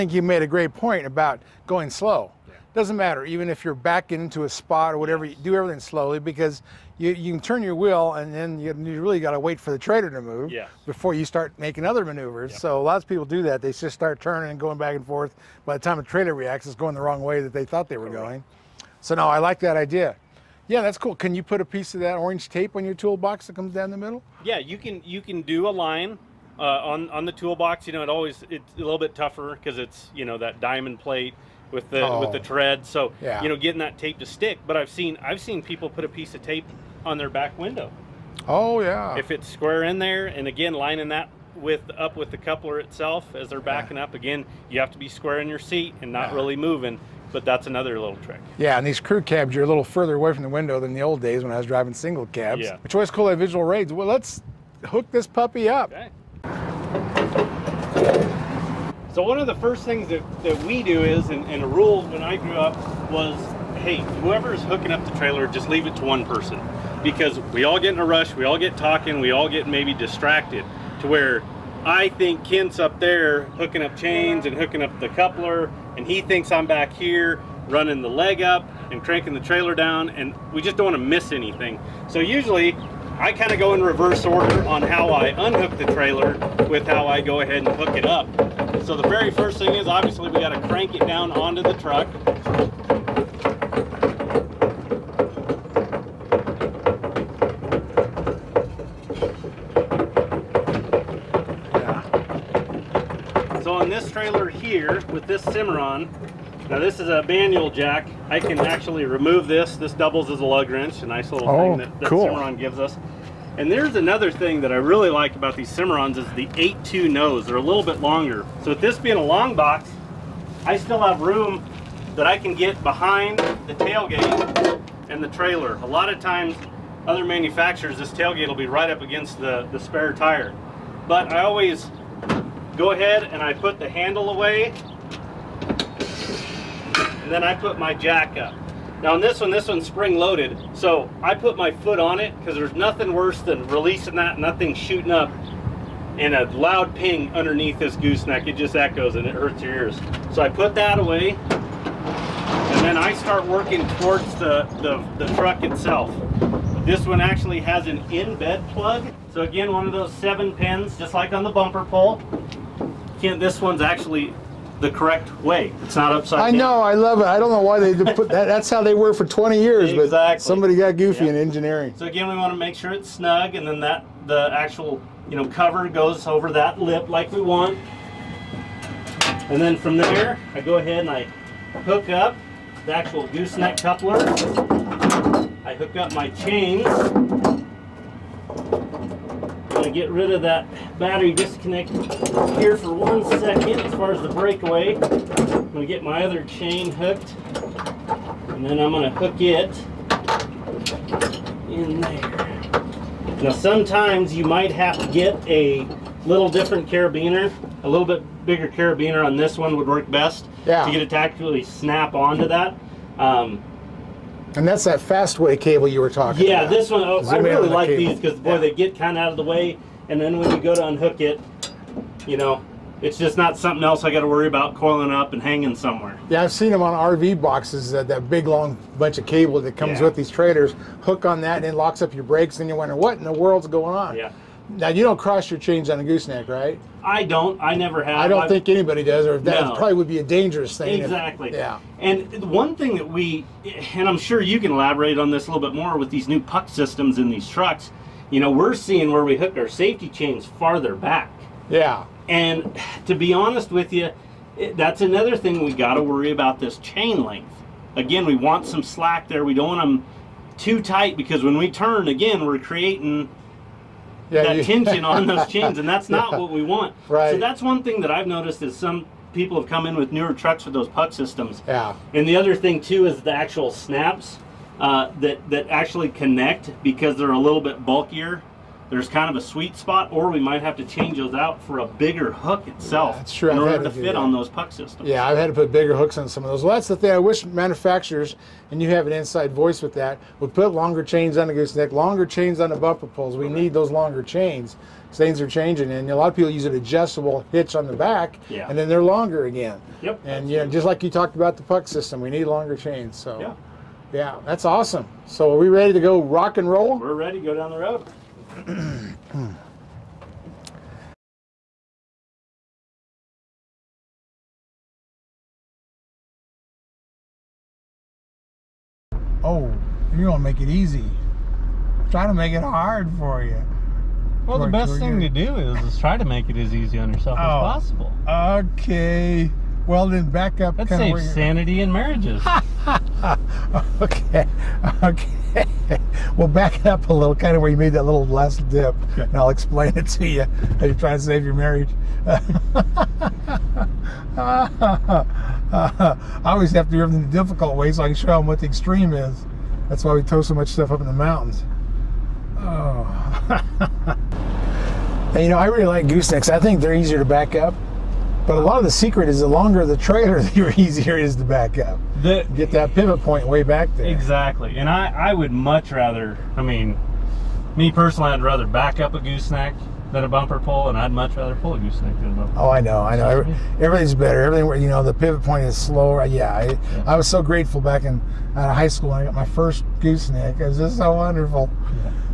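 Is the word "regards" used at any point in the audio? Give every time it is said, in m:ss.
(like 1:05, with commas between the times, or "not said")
not said.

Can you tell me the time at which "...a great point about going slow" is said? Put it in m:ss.
0:00.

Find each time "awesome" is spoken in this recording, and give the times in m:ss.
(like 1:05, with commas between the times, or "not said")
5:04.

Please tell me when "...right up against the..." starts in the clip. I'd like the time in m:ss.
2:08.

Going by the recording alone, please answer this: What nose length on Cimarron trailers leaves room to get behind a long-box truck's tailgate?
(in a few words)
8.2.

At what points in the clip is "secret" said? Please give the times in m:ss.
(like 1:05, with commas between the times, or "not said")
5:58.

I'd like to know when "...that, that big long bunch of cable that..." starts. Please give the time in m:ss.
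3:47.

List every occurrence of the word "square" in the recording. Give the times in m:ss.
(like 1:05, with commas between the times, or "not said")
0:39, 0:45.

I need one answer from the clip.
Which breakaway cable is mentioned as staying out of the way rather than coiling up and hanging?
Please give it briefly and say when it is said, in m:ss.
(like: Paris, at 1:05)
Fastway, at 3:34.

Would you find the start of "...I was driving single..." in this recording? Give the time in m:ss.
0:51.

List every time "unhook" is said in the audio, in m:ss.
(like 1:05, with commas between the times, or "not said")
1:25, 3:40.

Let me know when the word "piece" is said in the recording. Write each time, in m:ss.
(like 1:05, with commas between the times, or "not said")
0:21, 0:36.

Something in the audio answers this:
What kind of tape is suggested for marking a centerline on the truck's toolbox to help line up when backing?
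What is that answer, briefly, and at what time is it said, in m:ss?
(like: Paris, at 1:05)
orange tape, at 0:22.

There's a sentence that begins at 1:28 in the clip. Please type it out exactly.
So the very first thing is obviously we got to crank it down onto the truck.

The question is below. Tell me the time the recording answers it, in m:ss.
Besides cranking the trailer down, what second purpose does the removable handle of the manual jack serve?
1:50.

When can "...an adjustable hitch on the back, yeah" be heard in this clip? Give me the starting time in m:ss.
4:56.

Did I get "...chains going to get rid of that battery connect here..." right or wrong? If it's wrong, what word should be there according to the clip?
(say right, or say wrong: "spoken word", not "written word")
wrong: "disconnect", not "connect".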